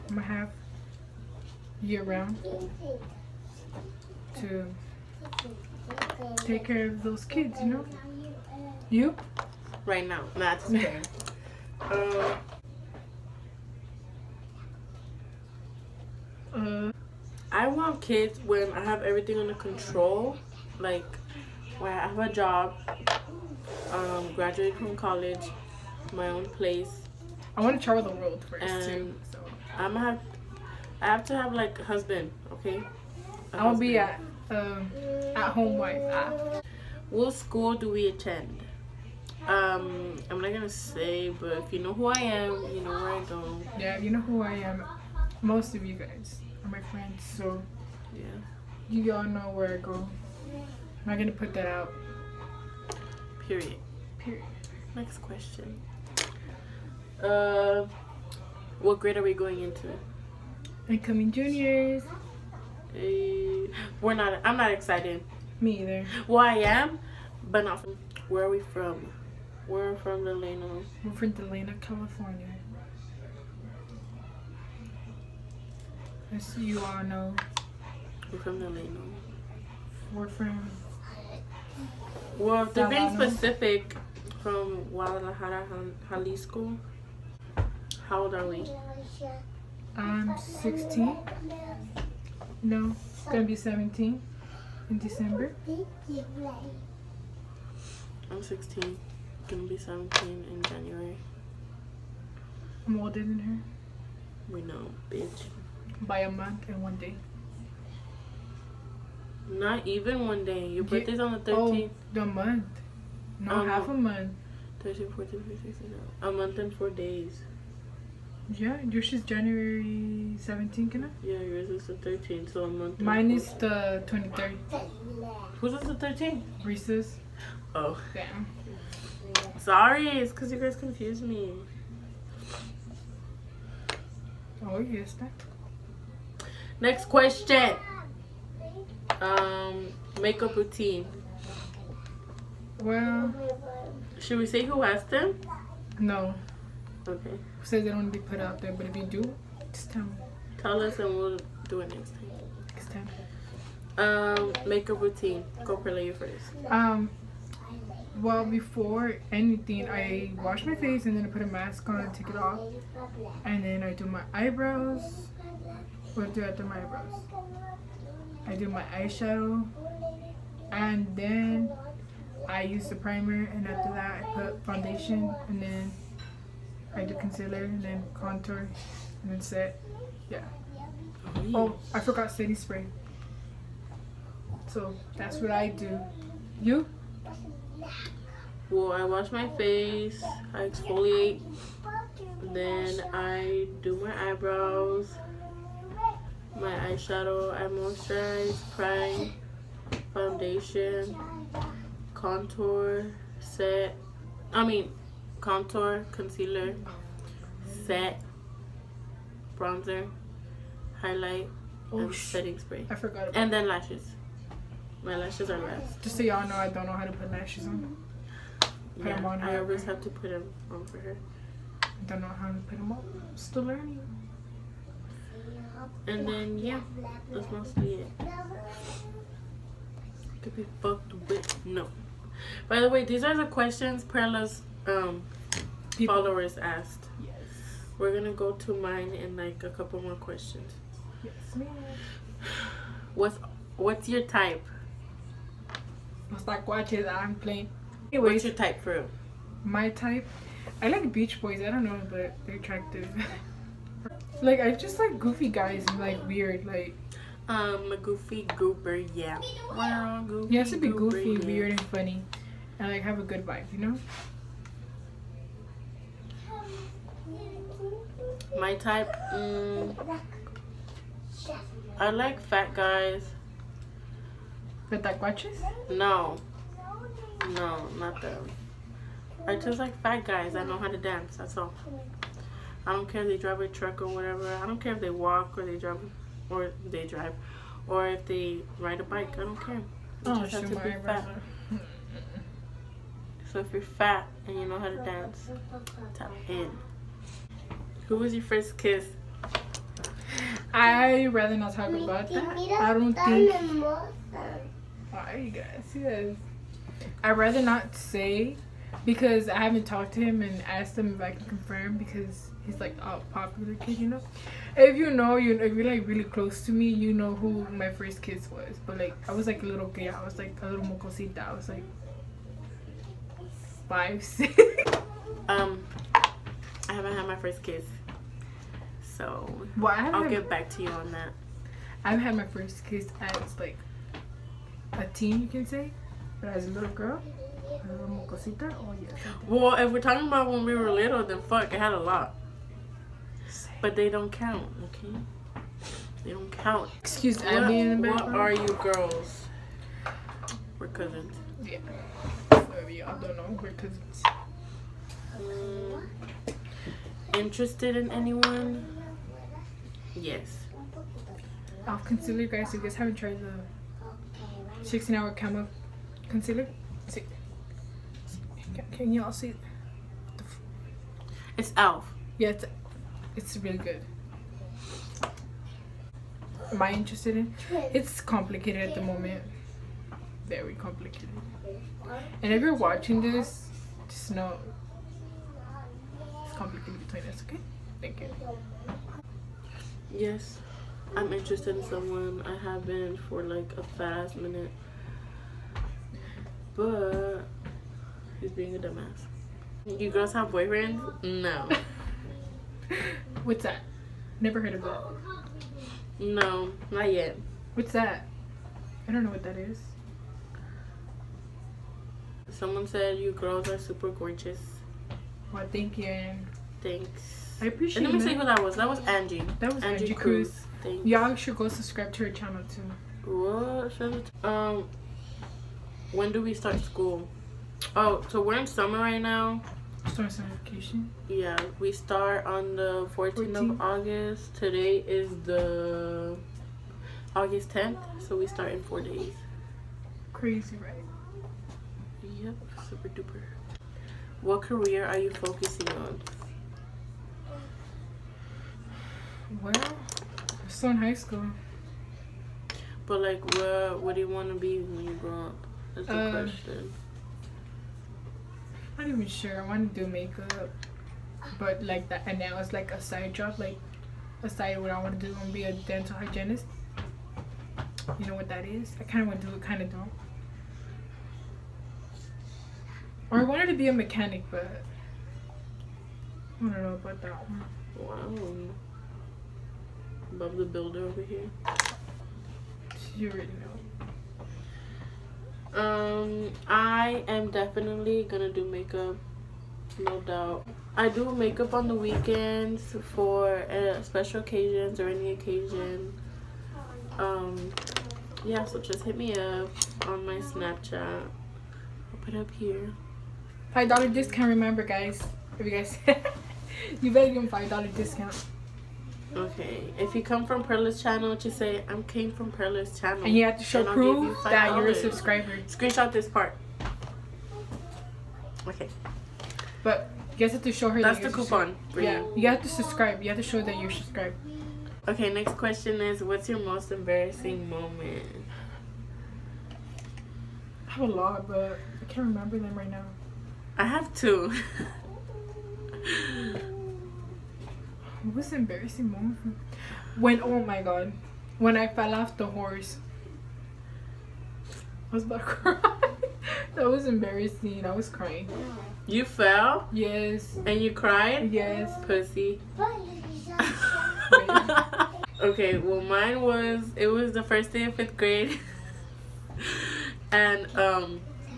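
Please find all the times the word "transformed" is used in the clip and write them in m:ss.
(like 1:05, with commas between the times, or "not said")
not said.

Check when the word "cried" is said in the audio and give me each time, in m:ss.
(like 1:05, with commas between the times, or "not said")
9:10.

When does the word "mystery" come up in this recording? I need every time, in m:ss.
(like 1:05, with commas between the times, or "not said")
not said.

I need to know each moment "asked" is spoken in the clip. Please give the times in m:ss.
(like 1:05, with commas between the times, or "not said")
2:24, 3:56, 5:10.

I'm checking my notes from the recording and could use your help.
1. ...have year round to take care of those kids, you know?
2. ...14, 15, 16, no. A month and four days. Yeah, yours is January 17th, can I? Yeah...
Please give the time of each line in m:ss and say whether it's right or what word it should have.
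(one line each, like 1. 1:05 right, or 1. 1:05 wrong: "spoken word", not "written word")
1. 0:00 right
2. 1:55 right.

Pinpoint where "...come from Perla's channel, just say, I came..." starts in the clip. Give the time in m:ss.
8:30.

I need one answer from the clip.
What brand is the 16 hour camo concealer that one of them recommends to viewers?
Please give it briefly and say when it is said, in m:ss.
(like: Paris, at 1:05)
Elf, at 6:11.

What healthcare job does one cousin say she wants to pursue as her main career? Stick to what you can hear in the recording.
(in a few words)
Dental hygienist.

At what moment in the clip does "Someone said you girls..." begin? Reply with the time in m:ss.
6:52.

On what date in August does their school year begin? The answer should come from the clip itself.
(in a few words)
August 14.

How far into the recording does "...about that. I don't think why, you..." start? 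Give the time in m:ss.
5:01.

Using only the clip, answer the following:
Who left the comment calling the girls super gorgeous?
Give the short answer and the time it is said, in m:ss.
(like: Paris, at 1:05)
Angie Cruz, at 7:00.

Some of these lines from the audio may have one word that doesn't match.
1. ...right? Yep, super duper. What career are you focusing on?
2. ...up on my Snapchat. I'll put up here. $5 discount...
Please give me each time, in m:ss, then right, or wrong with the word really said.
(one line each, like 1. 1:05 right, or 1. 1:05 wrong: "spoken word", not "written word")
1. 7:20 right
2. 8:19 right.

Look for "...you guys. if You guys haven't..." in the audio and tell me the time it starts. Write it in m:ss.
6:02.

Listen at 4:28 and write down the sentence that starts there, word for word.
My type, mm, I like fat guys.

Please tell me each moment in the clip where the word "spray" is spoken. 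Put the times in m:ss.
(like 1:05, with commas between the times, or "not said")
3:02, 3:32.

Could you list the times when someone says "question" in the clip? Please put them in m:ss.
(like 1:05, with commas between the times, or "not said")
0:55, 2:17, 3:53, 4:00, 7:36, 8:45.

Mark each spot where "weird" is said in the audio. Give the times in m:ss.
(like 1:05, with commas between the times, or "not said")
4:16, 4:21.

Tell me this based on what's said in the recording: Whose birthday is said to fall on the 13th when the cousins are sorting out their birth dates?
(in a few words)
Reese.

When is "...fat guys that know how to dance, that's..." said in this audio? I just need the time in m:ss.
4:40.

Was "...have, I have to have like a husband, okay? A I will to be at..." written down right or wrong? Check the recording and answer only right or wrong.
right.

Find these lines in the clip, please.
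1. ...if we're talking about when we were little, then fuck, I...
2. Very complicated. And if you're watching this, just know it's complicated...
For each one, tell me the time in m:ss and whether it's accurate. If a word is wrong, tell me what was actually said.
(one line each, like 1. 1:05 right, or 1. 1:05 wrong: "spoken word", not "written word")
1. 5:39 right
2. 6:20 right.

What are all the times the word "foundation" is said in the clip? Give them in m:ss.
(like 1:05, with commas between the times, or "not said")
2:54, 3:20.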